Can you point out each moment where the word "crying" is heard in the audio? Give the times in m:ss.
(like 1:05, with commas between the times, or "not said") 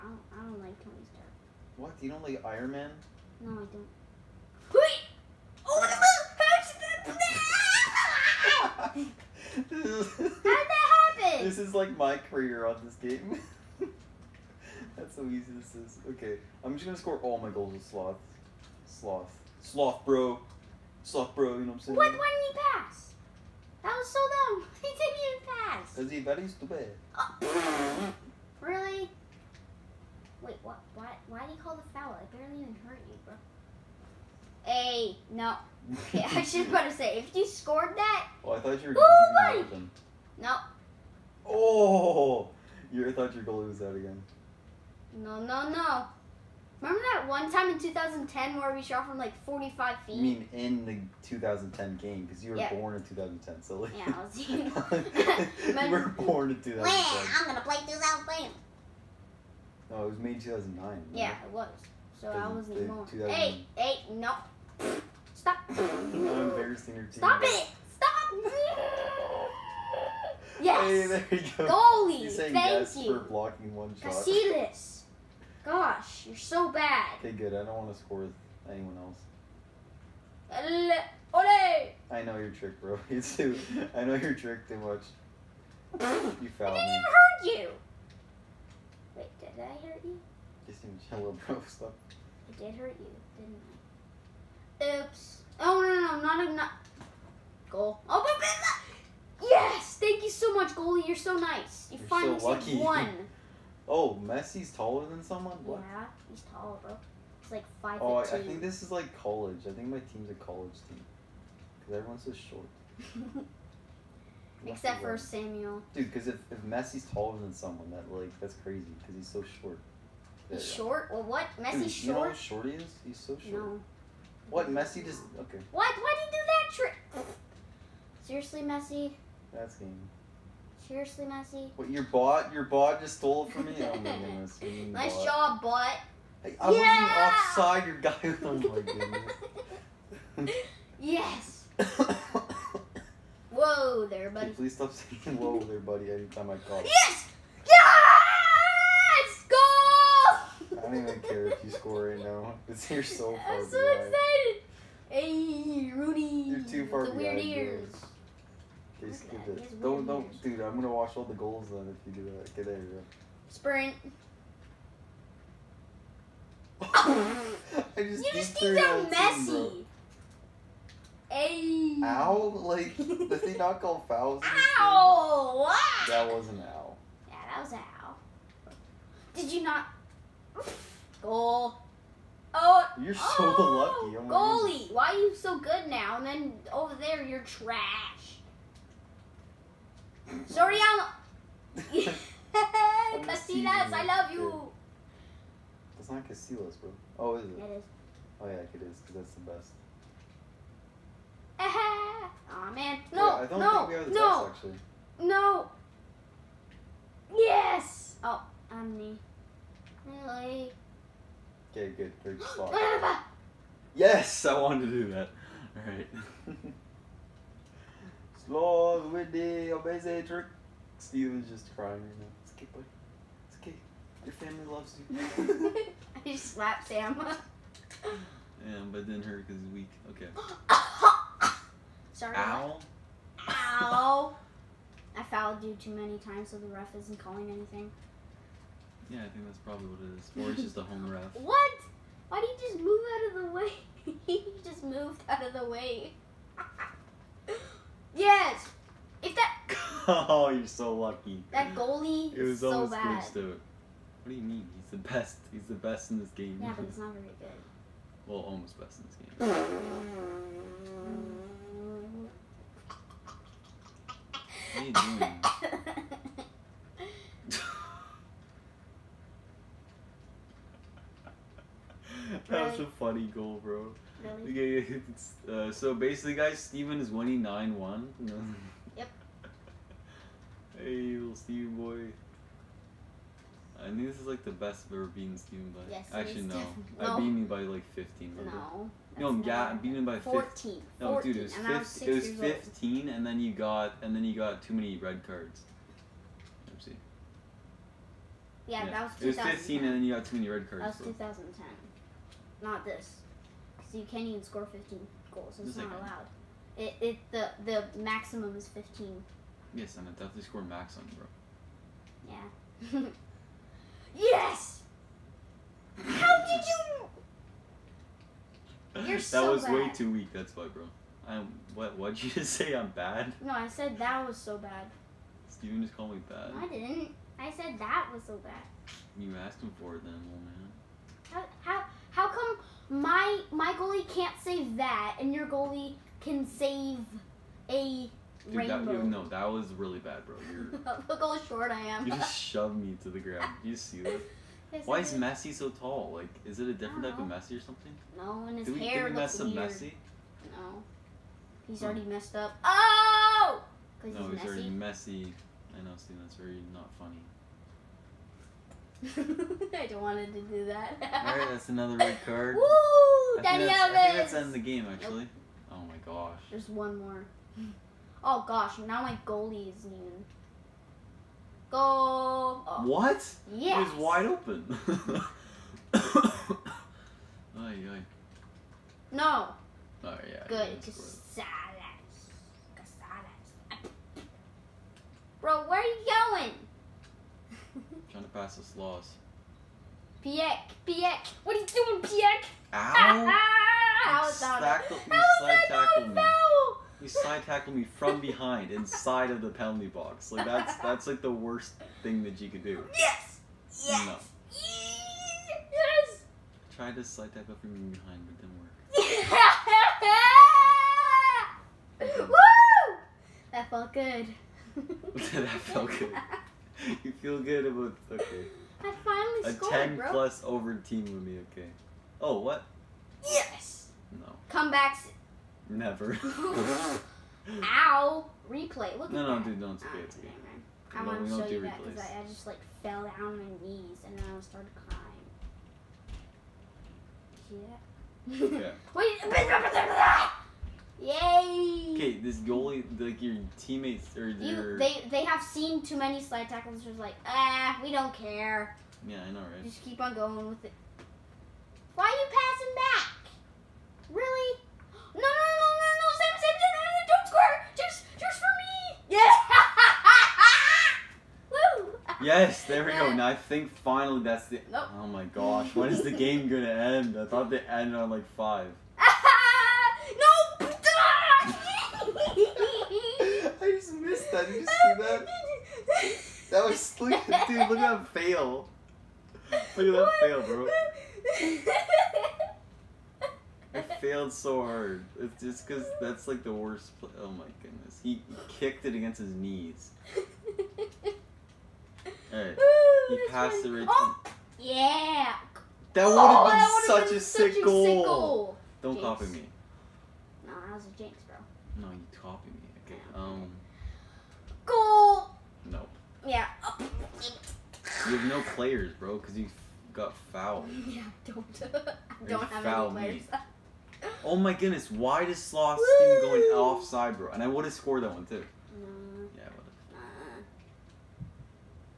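3:41, 7:14.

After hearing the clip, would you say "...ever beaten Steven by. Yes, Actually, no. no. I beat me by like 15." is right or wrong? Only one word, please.
right.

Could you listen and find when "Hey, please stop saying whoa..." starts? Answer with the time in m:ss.
2:24.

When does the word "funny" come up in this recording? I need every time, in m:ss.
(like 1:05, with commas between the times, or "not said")
4:32, 5:56.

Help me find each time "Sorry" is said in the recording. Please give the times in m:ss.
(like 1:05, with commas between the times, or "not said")
3:10, 3:52.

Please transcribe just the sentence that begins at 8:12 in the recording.
Hey, Ooh, he passed the return.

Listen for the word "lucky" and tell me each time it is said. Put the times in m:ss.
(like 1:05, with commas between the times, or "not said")
1:42, 3:04, 4:10.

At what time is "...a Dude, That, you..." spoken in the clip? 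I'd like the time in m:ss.
5:37.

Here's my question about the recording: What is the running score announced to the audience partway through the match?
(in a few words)
9-1.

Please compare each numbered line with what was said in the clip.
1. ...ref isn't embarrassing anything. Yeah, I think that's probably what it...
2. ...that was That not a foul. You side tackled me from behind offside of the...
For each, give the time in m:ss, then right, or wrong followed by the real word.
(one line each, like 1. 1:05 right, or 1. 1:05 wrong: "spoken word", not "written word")
1. 3:56 wrong: "calling", not "embarrassing"
2. 6:34 wrong: "inside", not "offside".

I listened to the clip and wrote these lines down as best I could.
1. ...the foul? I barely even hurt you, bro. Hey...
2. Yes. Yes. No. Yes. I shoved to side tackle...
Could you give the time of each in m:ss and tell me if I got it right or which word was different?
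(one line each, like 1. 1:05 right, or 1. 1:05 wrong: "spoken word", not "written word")
1. 0:31 right
2. 6:42 wrong: "tried", not "shoved".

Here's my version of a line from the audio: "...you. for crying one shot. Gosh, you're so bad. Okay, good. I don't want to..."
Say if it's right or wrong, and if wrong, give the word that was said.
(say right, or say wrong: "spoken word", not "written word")
wrong: "blocking", not "crying".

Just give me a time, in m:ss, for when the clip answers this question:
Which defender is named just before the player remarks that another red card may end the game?
6:03.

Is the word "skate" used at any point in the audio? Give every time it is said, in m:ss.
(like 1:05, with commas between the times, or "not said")
7:09.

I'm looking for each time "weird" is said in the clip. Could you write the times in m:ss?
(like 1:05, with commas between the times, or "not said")
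2:37, 5:49.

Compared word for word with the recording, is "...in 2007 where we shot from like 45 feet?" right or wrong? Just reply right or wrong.
wrong.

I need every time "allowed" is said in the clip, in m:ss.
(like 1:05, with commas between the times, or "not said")
5:05.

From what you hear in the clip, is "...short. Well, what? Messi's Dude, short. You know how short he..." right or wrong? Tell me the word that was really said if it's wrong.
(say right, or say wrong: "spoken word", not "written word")
right.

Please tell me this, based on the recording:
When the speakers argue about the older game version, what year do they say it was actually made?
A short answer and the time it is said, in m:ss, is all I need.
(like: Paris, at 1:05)
2009, at 1:00.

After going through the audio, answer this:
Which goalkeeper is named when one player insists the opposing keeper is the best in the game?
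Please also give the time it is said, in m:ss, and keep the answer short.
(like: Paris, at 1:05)
Casillas, at 3:16.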